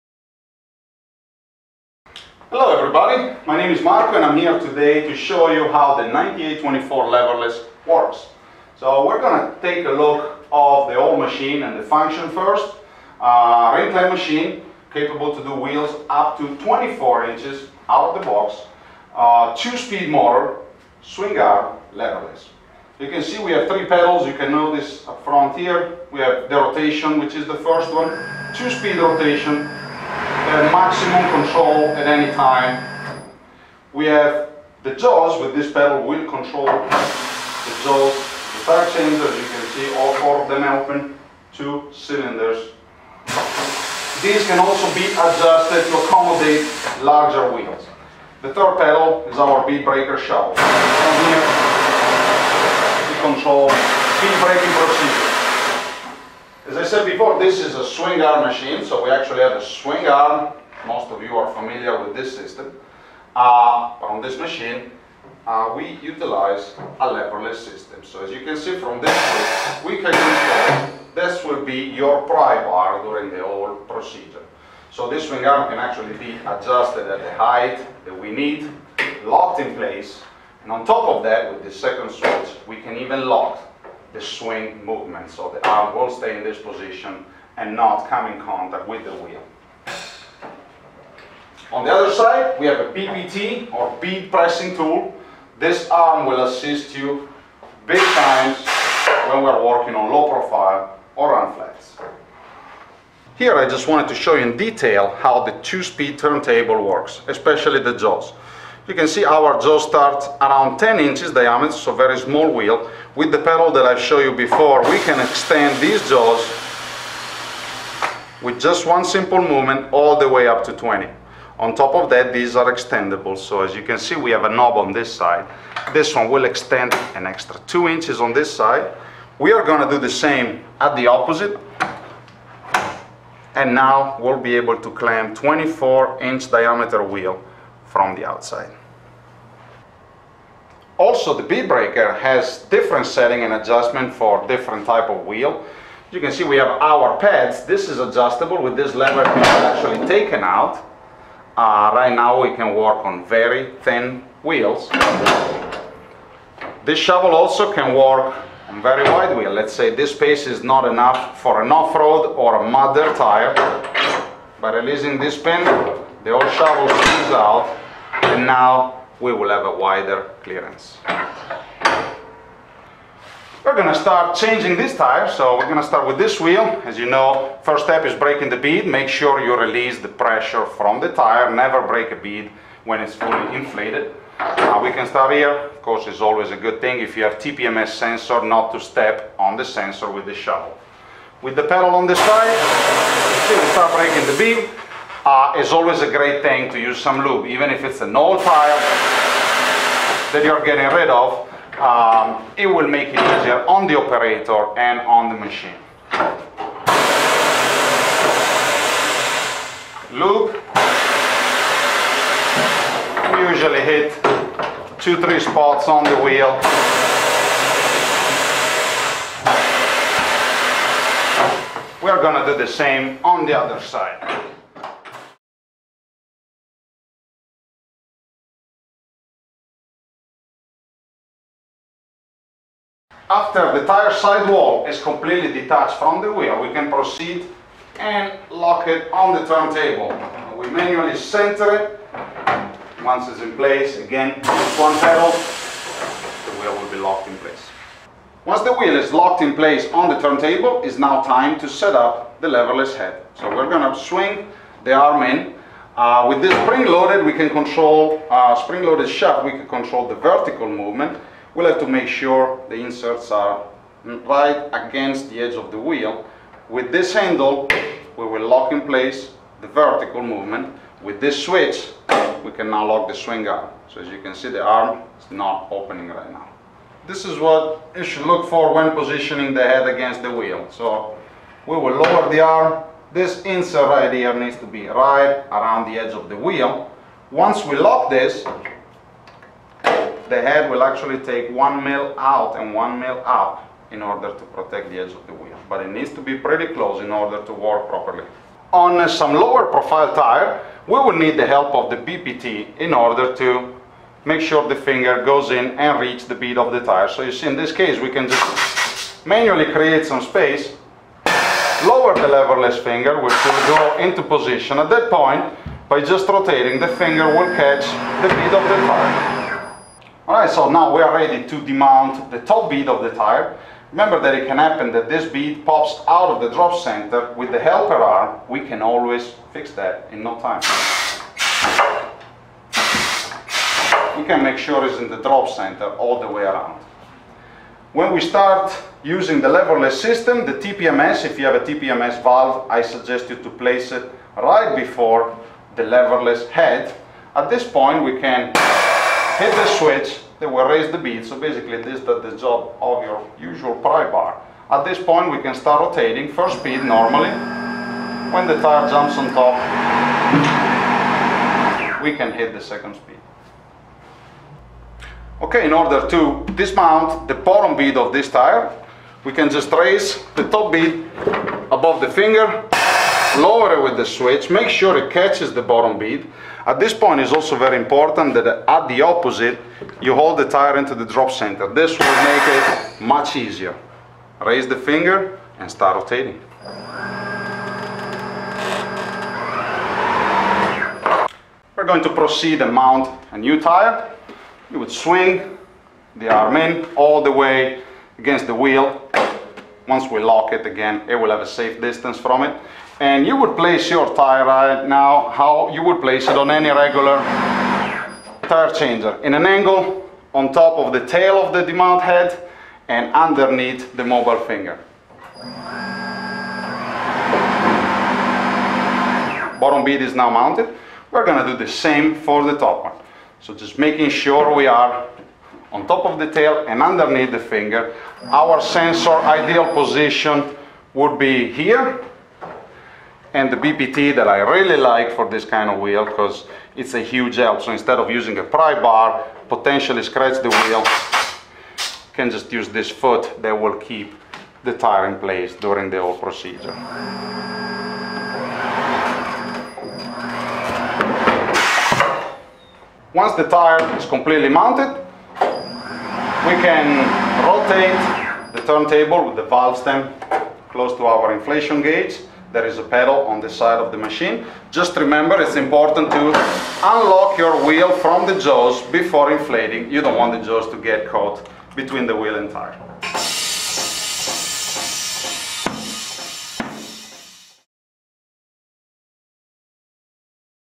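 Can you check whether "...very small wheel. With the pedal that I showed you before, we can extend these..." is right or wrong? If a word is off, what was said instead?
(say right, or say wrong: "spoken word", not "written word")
right.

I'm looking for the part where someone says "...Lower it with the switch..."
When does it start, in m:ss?
6:13.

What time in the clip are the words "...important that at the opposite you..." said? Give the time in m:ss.
6:17.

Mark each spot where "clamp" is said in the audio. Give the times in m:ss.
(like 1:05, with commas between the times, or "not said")
2:14.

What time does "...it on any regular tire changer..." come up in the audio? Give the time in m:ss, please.
6:46.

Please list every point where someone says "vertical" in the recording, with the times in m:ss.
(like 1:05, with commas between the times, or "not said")
4:20, 4:29.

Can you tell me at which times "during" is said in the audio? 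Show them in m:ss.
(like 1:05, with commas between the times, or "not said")
1:13, 7:25.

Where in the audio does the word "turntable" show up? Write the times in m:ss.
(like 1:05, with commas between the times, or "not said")
1:46, 3:59, 4:10, 7:38.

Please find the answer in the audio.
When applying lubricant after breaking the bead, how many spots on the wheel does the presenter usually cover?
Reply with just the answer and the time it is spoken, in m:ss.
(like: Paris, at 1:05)
two, three, at 3:34.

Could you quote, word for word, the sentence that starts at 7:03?
So just making sure we are on top of the tail and underneath the finger.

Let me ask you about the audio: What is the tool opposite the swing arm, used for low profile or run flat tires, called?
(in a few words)
bead pressing tool.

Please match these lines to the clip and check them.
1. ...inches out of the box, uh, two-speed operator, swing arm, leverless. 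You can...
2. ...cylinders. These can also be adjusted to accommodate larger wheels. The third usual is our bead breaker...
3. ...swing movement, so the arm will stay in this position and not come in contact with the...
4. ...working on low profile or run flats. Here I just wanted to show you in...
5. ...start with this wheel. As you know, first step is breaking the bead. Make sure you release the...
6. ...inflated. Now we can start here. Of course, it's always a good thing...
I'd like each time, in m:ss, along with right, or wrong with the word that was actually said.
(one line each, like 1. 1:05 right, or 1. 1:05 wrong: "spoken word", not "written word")
1. 0:17 wrong: "motor", not "operator"
2. 0:41 wrong: "pedal", not "usual"
3. 1:24 right
4. 1:39 right
5. 2:55 right
6. 3:03 right.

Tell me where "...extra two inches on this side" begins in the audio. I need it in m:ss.
2:07.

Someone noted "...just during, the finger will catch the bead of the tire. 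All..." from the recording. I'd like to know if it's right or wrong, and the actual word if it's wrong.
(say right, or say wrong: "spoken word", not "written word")
wrong: "rotating", not "during".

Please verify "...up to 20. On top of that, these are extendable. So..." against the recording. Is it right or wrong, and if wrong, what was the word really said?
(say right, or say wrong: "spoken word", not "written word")
right.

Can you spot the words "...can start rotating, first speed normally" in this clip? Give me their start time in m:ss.
5:55.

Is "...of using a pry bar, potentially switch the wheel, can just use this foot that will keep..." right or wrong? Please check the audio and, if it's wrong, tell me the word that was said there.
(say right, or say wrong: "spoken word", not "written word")
wrong: "scratch", not "switch".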